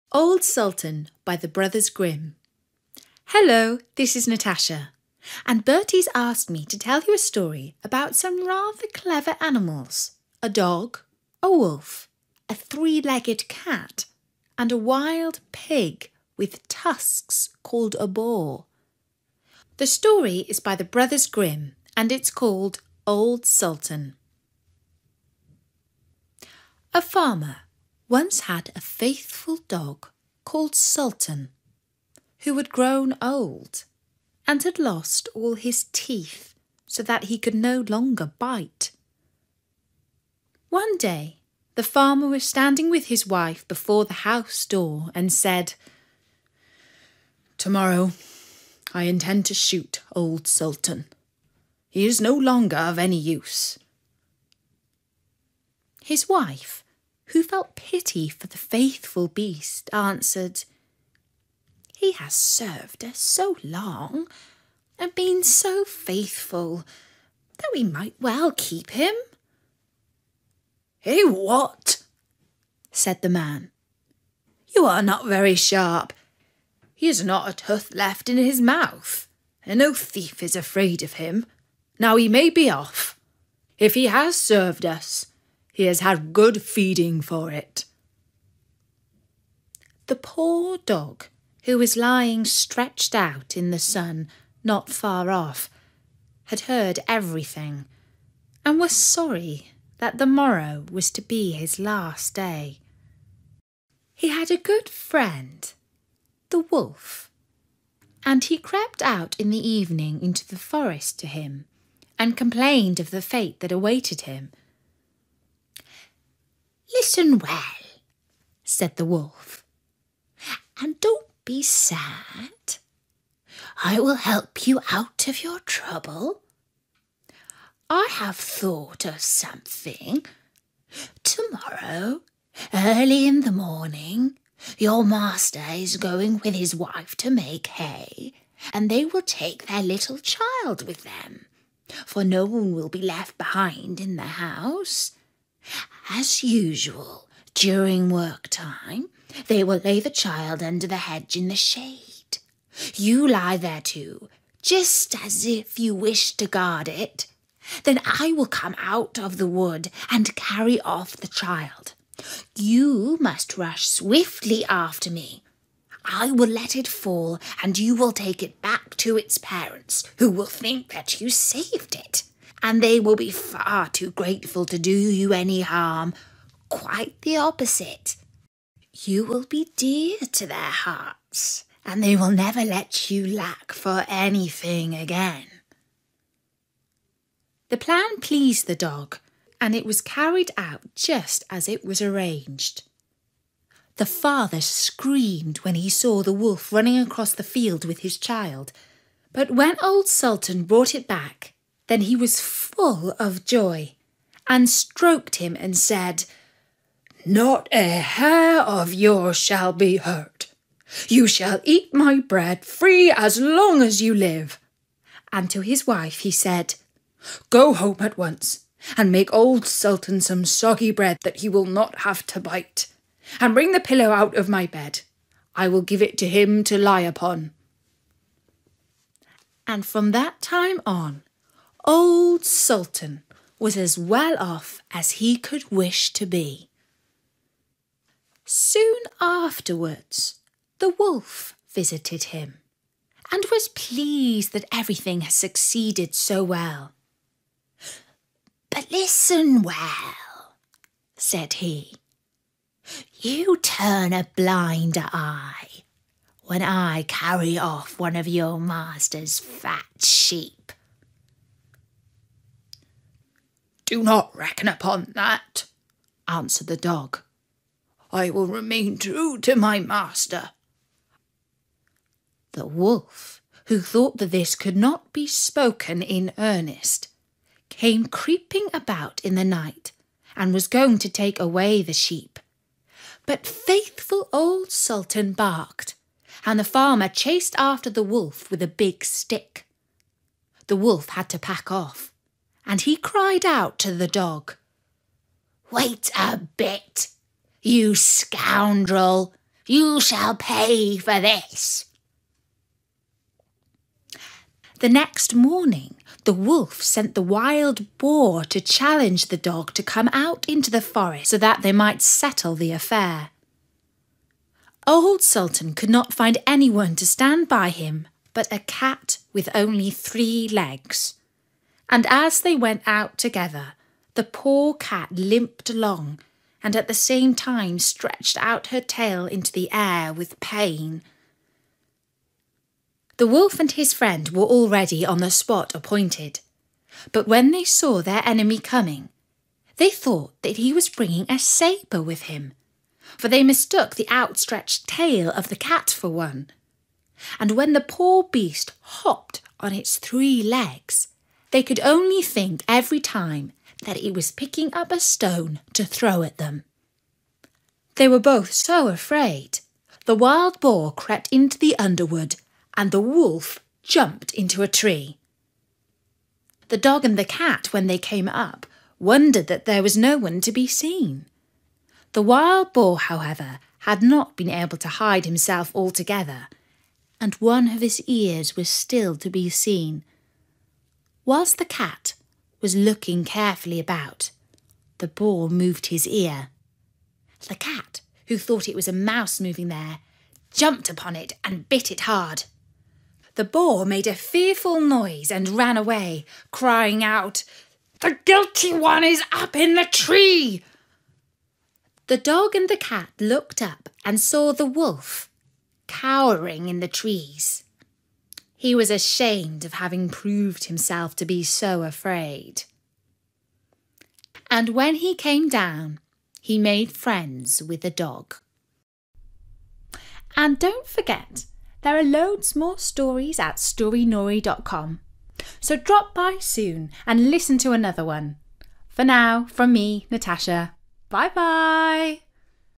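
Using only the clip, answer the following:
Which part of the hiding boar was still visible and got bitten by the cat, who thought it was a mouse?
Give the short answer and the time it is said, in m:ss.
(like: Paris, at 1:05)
His ear, at 6:17.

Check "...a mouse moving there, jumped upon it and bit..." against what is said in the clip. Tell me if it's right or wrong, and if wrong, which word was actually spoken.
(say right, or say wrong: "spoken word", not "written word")
right.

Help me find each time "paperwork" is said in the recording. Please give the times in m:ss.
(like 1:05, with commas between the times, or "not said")
not said.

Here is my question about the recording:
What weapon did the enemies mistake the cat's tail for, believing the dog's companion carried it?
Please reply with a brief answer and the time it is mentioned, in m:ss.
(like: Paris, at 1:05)
A sabre, at 5:41.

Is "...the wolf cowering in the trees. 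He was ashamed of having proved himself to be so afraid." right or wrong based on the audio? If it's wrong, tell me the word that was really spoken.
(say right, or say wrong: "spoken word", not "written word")
right.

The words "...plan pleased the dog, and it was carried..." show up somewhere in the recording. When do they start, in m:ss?
3:07.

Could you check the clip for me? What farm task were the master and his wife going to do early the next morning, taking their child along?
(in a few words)
Make hay.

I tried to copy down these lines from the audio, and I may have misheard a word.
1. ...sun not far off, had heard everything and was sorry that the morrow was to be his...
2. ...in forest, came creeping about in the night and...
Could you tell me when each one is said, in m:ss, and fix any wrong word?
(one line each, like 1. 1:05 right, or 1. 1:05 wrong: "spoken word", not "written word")
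1. 1:33 right
2. 4:36 wrong: "earnest", not "forest".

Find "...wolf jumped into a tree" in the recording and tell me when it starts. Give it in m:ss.
6:03.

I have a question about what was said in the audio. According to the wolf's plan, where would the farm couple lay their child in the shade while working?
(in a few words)
Under the hedge.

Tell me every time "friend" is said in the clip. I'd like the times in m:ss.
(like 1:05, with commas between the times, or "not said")
1:44, 5:33, 6:56.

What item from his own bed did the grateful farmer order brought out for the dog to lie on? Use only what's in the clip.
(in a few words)
The pillow.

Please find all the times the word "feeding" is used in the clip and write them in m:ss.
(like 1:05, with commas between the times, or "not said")
1:26.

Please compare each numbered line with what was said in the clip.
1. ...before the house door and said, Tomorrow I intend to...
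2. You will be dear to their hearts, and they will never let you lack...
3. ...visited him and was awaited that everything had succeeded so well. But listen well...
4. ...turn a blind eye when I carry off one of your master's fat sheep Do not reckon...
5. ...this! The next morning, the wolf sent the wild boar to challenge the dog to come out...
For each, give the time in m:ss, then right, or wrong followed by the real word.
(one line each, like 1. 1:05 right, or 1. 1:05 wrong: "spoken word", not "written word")
1. 0:43 right
2. 2:58 right
3. 4:01 wrong: "pleased", not "awaited"
4. 4:13 right
5. 5:01 right.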